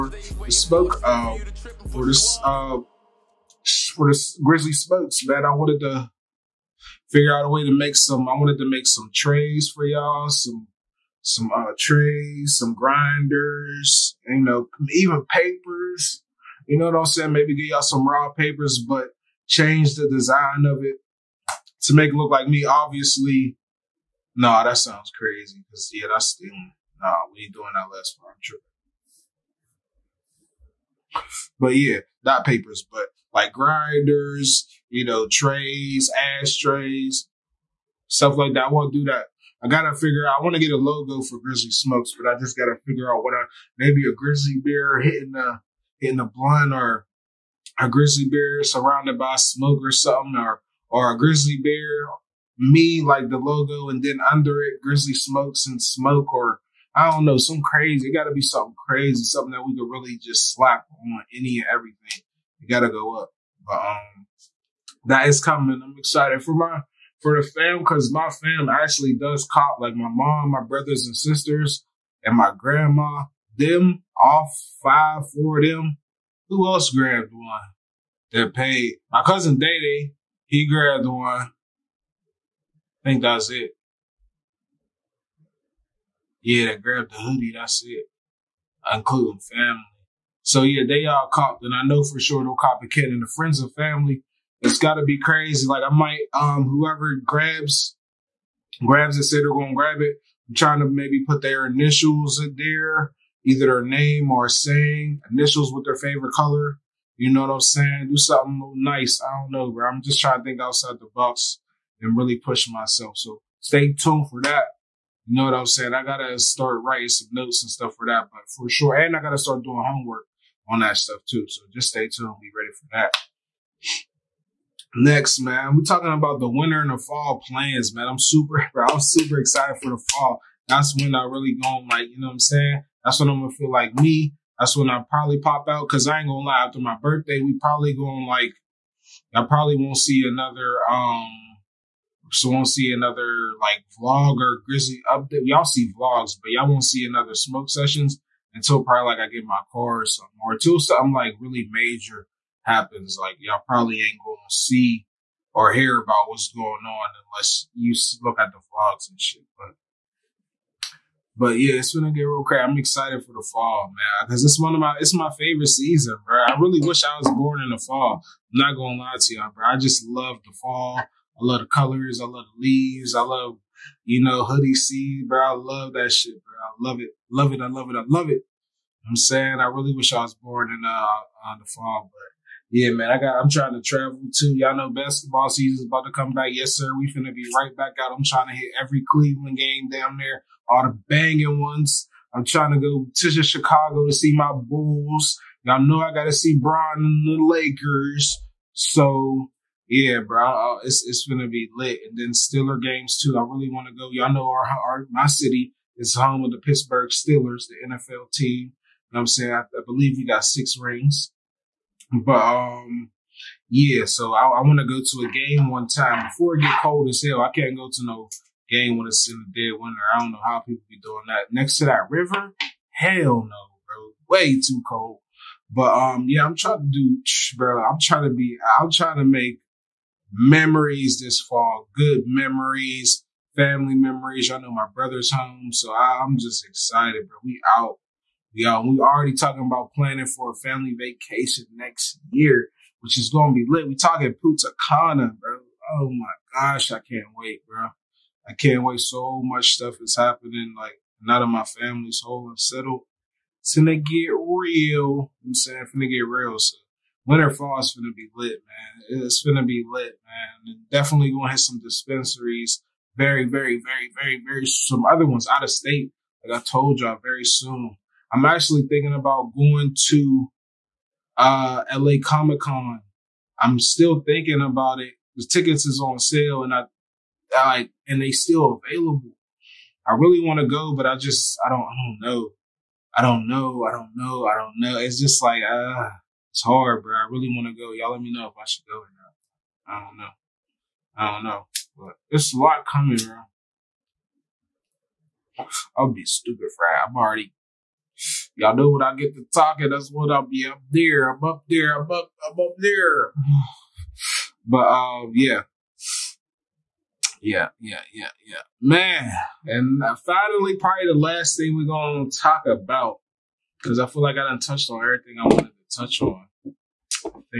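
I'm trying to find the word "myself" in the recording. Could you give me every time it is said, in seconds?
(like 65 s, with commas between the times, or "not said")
112 s.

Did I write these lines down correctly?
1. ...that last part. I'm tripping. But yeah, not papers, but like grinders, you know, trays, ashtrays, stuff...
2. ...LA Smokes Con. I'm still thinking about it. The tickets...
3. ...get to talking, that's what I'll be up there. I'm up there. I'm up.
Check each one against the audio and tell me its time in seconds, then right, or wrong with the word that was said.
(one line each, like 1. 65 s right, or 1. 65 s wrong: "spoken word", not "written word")
1. 27 s right
2. 271 s wrong: "Comic", not "Smokes"
3. 299 s right.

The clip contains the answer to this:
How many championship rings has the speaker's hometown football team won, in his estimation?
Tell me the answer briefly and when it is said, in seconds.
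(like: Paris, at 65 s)
6, at 210 s.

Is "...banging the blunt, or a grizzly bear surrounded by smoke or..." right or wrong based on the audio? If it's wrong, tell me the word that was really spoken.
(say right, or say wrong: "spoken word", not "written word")
wrong: "hitting", not "banging".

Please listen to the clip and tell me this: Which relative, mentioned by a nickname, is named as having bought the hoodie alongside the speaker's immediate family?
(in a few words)
Dayday.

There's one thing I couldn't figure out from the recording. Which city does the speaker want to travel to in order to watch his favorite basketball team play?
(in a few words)
Chicago.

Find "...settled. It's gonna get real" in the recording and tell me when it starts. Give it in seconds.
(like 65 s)
252 s.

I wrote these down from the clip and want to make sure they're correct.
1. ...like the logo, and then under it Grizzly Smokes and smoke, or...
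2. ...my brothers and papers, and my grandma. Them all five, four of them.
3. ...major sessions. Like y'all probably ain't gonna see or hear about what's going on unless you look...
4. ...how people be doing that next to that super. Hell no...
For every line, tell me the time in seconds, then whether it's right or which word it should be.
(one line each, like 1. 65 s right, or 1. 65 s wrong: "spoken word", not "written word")
1. 53 s right
2. 70 s wrong: "sisters", not "papers"
3. 151 s wrong: "happens", not "sessions"
4. 220 s wrong: "river", not "super".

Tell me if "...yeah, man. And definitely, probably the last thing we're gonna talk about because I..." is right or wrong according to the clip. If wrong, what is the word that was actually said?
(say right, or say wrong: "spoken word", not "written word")
wrong: "finally", not "definitely".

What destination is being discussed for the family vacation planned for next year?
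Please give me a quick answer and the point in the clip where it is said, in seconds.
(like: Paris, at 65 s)
Punta Cana, at 244 s.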